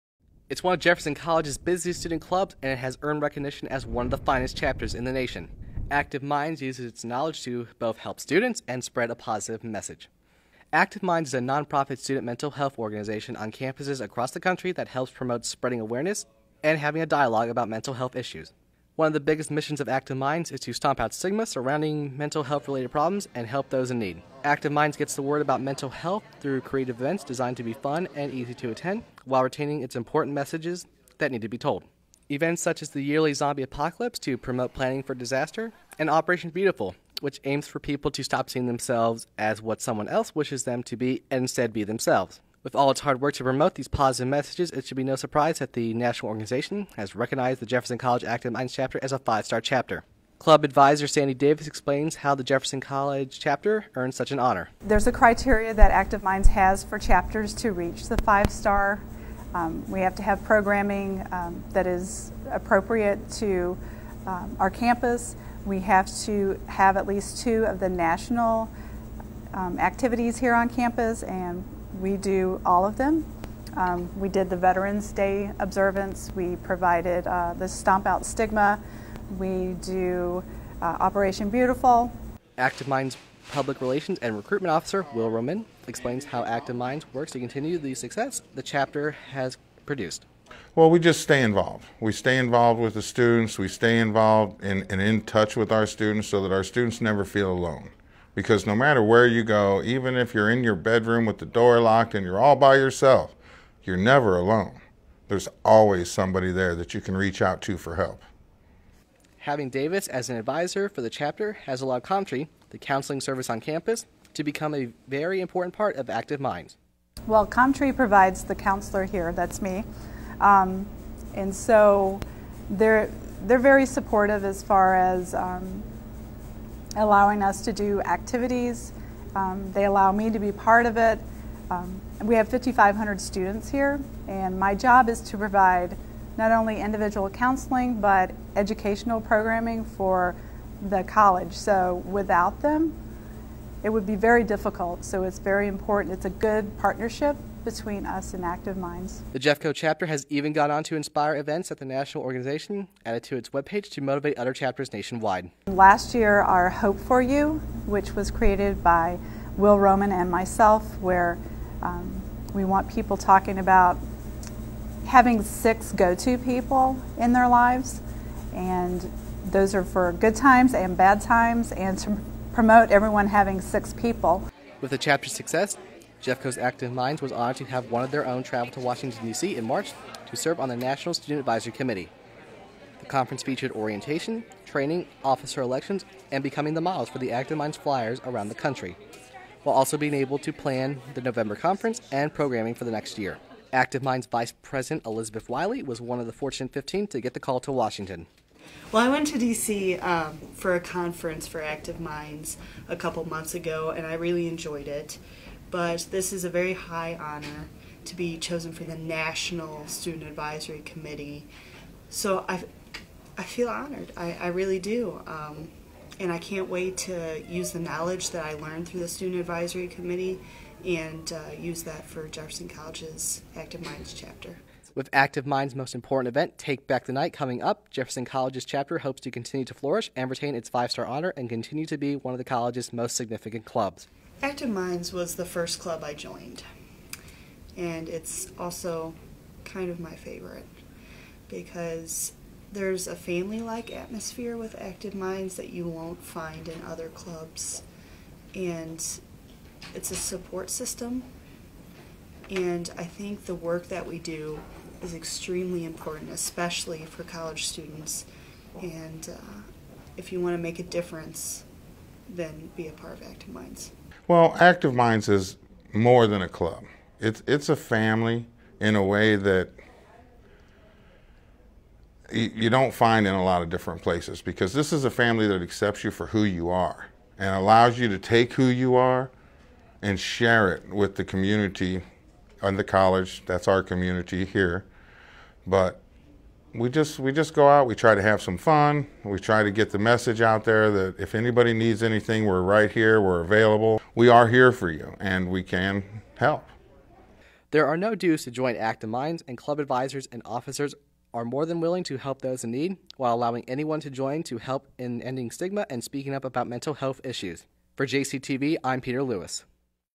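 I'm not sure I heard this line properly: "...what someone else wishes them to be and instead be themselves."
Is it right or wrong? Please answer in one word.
right.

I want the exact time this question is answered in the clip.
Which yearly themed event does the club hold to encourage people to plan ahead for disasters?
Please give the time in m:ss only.
0:33.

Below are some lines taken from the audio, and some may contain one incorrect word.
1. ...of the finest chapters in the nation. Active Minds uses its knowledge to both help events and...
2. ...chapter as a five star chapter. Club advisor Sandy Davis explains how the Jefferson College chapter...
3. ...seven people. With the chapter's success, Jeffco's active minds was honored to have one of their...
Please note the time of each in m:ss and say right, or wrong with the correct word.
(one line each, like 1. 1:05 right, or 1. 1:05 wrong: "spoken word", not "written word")
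1. 0:04 wrong: "students", not "events"
2. 0:48 right
3. 2:53 wrong: "six", not "seven".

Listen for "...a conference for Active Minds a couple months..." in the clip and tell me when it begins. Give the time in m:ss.
3:20.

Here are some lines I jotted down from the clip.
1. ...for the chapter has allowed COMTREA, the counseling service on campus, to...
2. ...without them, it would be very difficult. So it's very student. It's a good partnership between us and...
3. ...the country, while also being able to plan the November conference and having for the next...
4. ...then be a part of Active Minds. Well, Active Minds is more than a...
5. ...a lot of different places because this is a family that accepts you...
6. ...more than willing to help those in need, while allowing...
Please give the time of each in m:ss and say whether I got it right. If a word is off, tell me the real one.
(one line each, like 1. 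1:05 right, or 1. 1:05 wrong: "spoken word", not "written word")
1. 1:50 right
2. 2:22 wrong: "important", not "student"
3. 3:08 wrong: "programming", not "having"
4. 4:22 right
5. 4:33 right
6. 5:01 right.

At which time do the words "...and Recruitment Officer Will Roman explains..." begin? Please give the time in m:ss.
1:24.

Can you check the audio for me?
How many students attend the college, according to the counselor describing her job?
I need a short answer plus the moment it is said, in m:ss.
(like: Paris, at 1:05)
5,500, at 2:12.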